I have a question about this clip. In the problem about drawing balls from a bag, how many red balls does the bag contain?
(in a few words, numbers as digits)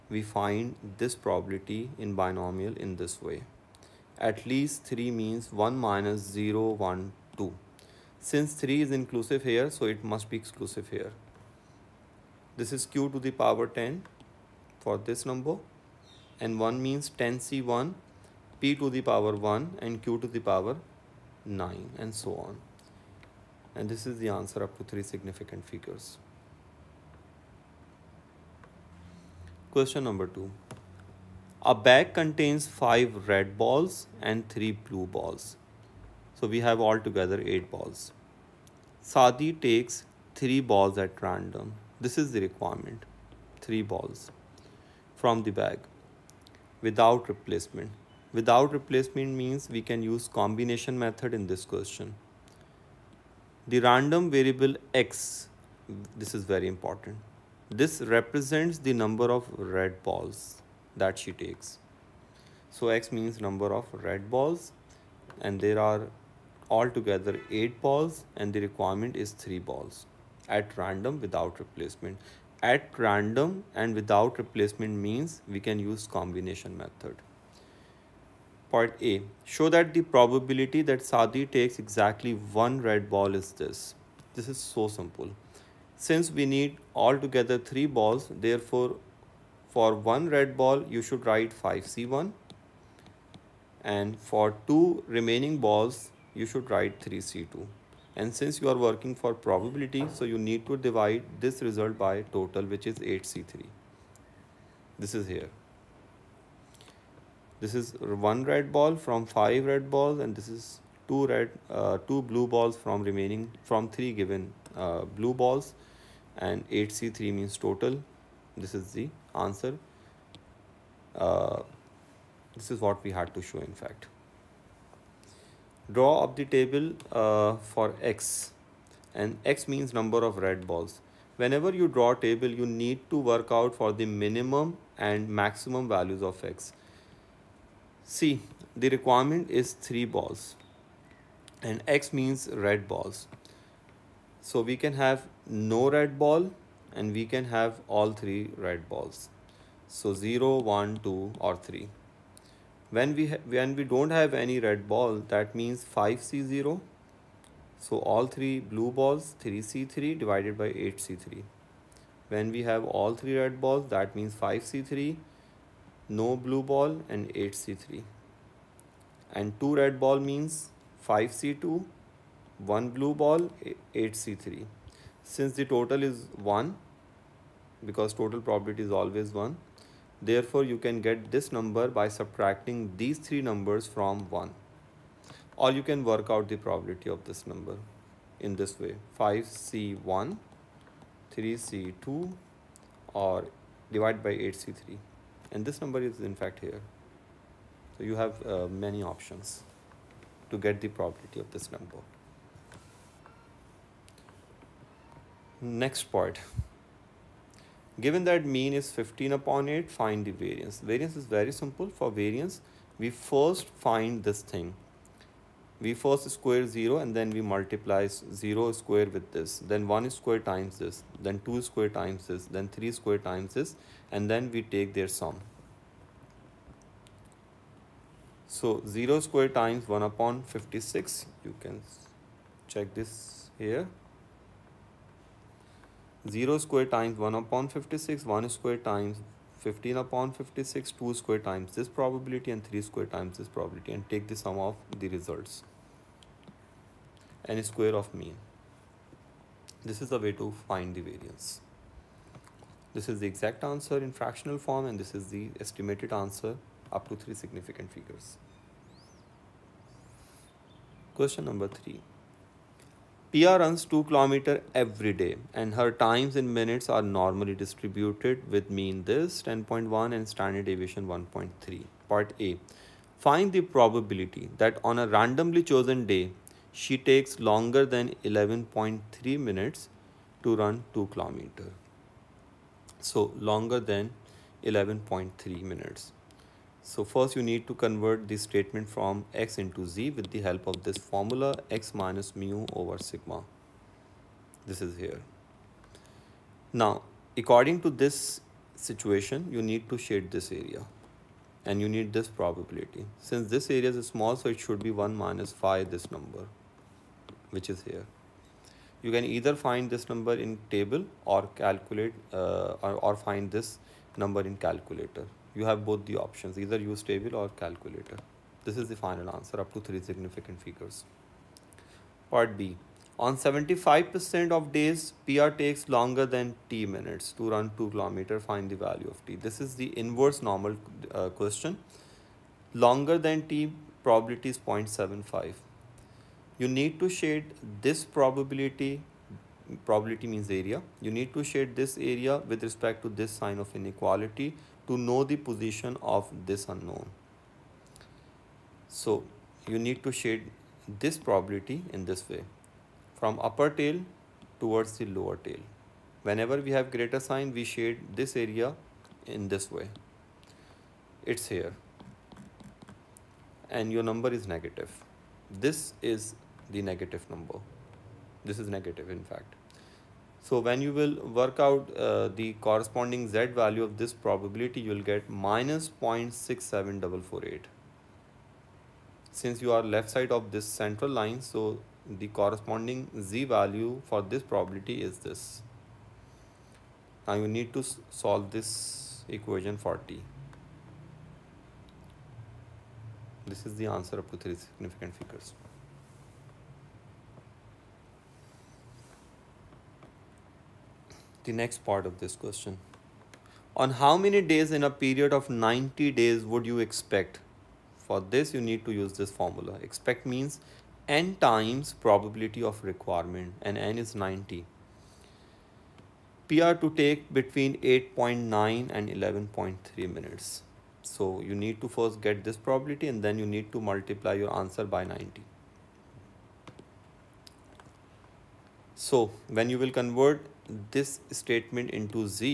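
5.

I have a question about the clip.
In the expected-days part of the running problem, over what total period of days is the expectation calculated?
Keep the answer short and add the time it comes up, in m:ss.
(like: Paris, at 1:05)
90 days, at 6:45.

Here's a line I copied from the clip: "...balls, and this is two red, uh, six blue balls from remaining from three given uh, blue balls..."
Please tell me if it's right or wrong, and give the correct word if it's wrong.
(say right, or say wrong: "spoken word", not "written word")
wrong: "two", not "six".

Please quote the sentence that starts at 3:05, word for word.
Or you can work out the probability of this number in this way.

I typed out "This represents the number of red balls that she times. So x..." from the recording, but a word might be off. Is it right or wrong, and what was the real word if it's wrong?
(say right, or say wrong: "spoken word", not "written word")
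wrong: "takes", not "times".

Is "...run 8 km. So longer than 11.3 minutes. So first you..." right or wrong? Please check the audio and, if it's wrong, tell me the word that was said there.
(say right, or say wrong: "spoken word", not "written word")
wrong: "2", not "8".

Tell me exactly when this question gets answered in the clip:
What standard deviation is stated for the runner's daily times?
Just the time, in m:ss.
4:31.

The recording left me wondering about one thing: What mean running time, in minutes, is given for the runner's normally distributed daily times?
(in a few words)
10.1.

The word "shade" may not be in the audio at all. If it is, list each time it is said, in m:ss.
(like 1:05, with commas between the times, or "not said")
5:00, 5:37, 5:41, 5:50, 5:57.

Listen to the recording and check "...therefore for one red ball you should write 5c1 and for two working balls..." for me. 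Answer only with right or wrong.
wrong.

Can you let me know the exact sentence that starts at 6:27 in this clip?
Now you need to solve this equation 40.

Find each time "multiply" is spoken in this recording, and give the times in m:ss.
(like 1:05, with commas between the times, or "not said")
3:37, 7:03.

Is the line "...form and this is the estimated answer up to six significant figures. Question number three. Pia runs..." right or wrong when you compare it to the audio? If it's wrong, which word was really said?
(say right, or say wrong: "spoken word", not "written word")
wrong: "three", not "six".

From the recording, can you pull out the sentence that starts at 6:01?
It's here and your number is negative.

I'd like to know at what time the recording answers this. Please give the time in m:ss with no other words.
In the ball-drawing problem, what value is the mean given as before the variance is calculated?
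3:28.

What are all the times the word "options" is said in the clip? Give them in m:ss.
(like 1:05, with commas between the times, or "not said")
3:19, 5:16.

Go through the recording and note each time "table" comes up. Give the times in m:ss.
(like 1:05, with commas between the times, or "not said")
2:06, 2:12, 5:10, 5:17.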